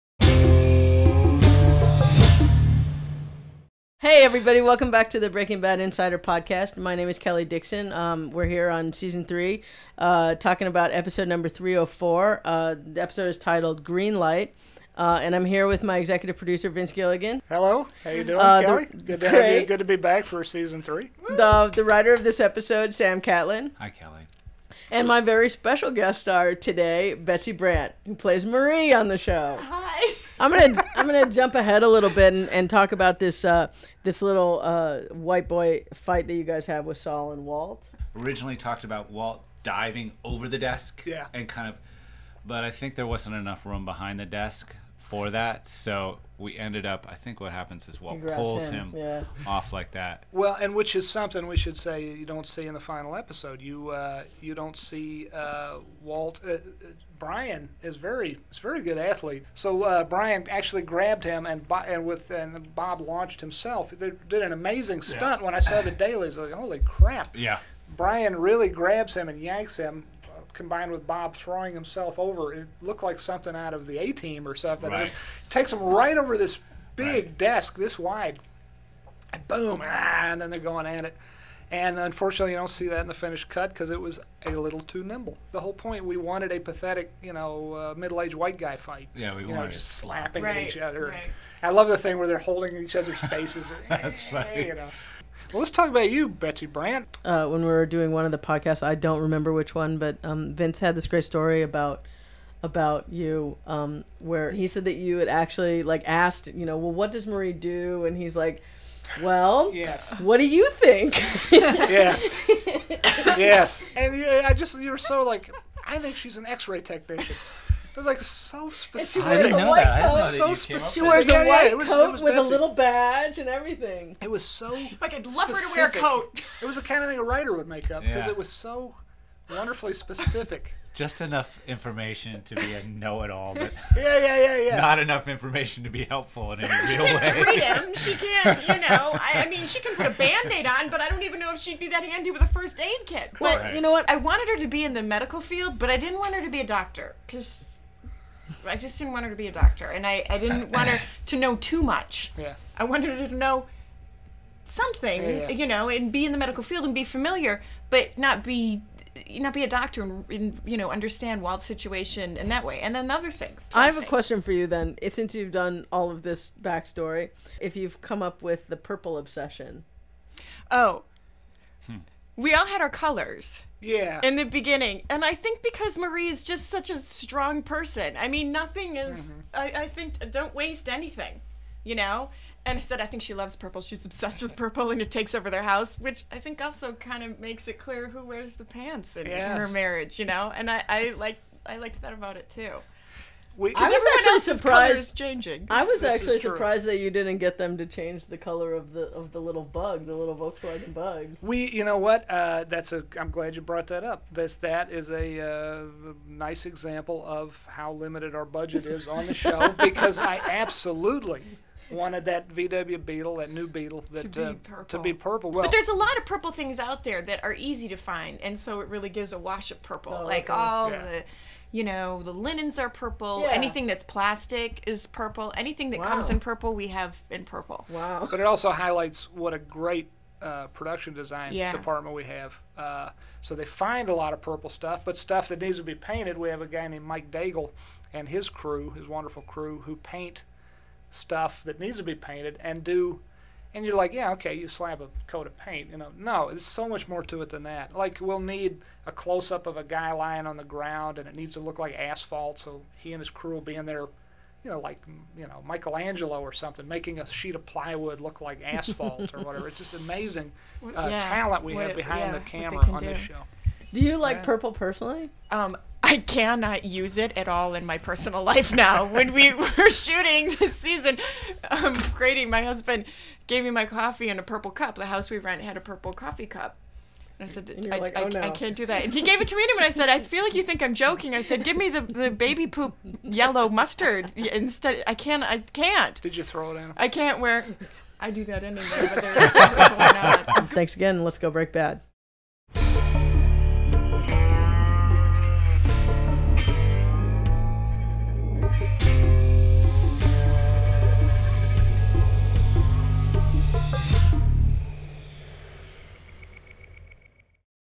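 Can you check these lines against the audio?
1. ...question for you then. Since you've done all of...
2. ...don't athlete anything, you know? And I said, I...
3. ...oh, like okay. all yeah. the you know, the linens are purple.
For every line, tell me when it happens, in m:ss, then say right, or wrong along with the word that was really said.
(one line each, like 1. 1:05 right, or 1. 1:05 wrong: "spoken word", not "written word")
1. 2:44 right
2. 3:00 wrong: "waste", not "athlete"
3. 3:40 right.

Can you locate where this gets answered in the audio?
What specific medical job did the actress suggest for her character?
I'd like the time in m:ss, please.
1:56.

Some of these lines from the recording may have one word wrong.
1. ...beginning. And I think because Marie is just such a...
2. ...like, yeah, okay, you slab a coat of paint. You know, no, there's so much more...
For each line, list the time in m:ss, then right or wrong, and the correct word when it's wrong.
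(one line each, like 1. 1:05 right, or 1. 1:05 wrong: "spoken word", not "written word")
1. 2:54 right
2. 4:03 right.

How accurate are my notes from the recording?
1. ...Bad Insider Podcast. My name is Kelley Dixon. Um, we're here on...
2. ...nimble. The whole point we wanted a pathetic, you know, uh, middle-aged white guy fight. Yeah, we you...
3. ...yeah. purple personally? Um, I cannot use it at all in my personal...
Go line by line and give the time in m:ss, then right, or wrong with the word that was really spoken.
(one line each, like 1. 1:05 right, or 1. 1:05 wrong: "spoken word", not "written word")
1. 0:05 right
2. 1:25 right
3. 4:24 right.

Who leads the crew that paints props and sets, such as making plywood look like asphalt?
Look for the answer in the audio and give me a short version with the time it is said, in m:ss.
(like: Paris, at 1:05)
Mike Daigle, at 3:57.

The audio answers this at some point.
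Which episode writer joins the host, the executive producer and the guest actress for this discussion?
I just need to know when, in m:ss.
0:22.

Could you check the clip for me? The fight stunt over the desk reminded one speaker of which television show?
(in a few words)
The A Team.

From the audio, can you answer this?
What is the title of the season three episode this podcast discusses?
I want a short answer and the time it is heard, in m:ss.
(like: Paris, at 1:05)
Green Light, at 0:13.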